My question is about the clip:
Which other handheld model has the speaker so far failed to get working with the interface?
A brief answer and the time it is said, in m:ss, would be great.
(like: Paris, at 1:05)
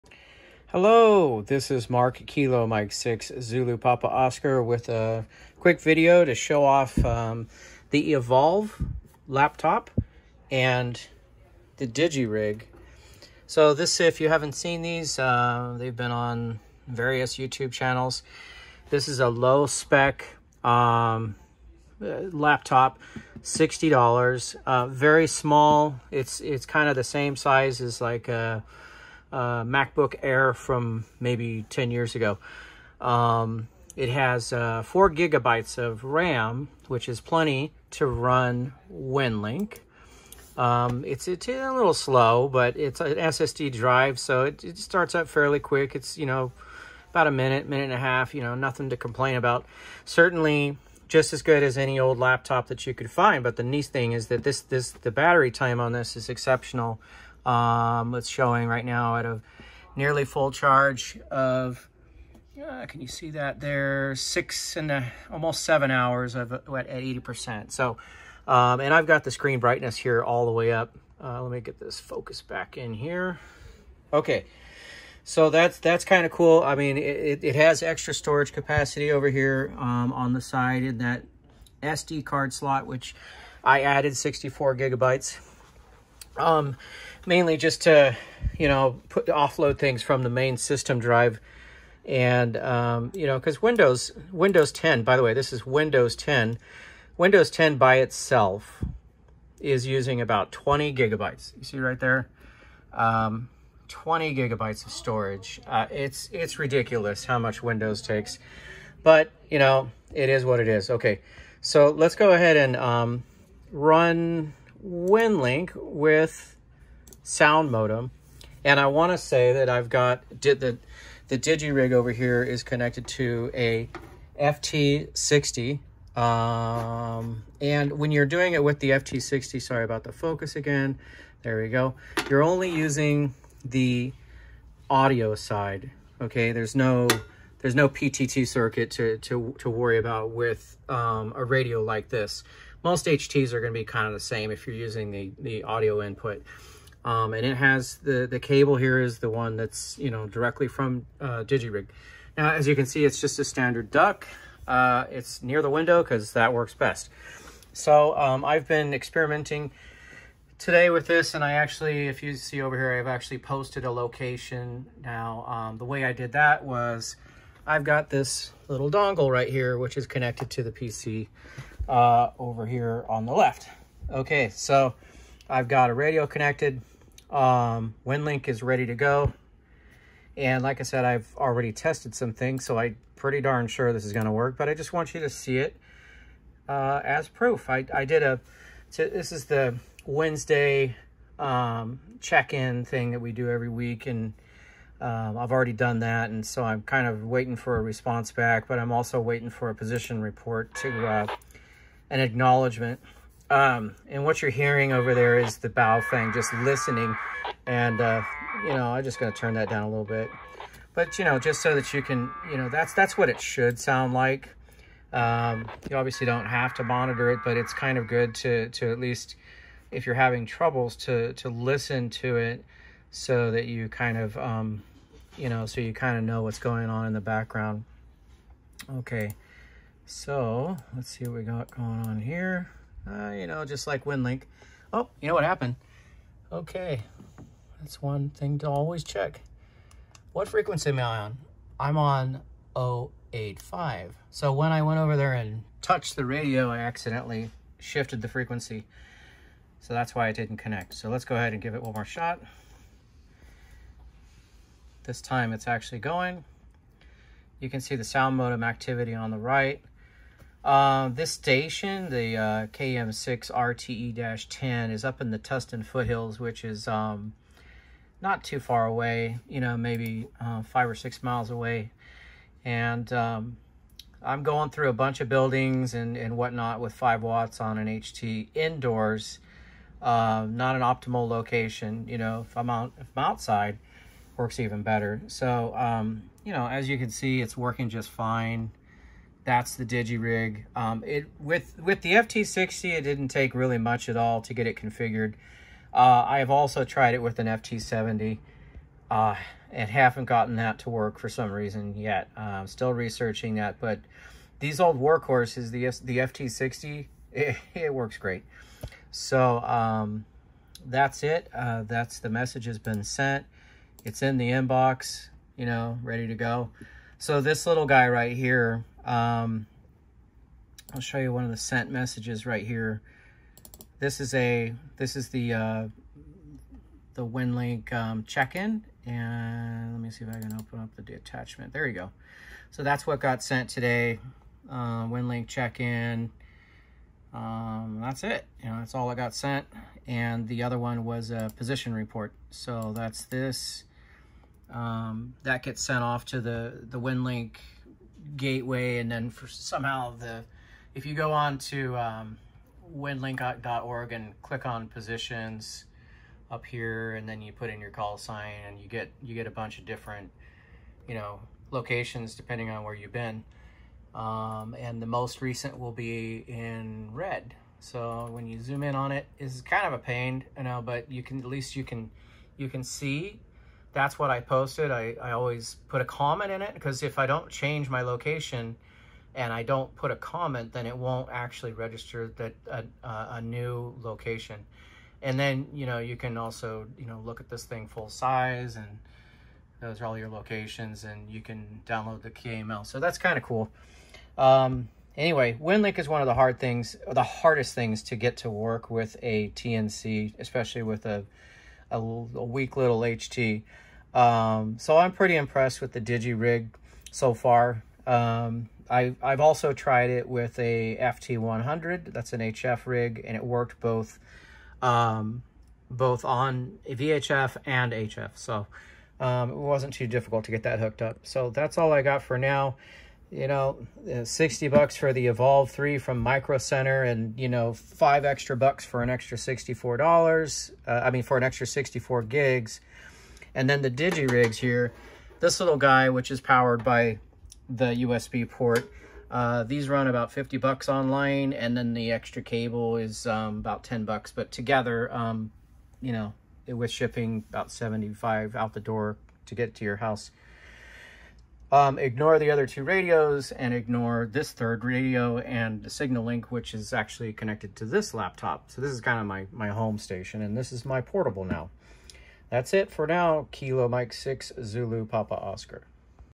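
FT70, at 4:57.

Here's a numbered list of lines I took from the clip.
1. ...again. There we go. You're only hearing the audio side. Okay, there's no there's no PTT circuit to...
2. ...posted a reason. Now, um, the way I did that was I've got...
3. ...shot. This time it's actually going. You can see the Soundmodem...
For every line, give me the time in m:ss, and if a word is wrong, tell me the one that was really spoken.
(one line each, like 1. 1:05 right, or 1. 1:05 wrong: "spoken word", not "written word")
1. 2:10 wrong: "using", not "hearing"
2. 2:43 wrong: "location", not "reason"
3. 4:12 right.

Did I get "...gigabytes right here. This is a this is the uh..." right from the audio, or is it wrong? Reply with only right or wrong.
wrong.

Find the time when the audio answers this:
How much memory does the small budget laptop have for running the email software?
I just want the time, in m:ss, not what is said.
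0:34.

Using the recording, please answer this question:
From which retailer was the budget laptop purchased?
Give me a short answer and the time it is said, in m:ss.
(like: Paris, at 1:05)
Micro Center, at 7:06.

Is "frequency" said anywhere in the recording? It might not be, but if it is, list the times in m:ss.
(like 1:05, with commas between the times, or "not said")
4:00, 4:08.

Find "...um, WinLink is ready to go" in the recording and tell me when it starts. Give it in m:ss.
2:57.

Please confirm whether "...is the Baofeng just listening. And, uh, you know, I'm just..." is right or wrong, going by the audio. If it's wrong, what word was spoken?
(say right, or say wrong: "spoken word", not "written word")
right.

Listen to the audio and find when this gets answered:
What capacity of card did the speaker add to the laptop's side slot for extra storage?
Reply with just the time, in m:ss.
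1:24.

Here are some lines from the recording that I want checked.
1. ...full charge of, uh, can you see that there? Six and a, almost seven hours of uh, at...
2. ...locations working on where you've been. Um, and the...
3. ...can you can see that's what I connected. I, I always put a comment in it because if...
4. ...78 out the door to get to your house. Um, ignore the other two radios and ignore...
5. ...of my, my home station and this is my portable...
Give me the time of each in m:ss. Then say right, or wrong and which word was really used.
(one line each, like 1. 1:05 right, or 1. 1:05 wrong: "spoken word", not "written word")
1. 1:00 right
2. 6:01 wrong: "depending", not "working"
3. 6:11 wrong: "posted", not "connected"
4. 7:27 wrong: "75", not "78"
5. 7:39 right.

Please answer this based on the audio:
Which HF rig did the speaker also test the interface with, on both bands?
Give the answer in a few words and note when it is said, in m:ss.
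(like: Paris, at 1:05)
FT100, at 6:50.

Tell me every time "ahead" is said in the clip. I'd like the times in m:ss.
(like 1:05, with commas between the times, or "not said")
1:52, 4:11.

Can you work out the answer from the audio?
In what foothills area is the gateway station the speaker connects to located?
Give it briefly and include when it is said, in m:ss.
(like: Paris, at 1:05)
Tustin foothills, at 4:25.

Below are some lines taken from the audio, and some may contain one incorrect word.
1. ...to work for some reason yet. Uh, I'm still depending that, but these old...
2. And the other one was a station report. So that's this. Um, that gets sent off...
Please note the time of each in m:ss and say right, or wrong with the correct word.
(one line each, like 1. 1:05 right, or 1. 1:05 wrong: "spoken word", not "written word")
1. 5:00 wrong: "researching", not "depending"
2. 5:40 wrong: "position", not "station".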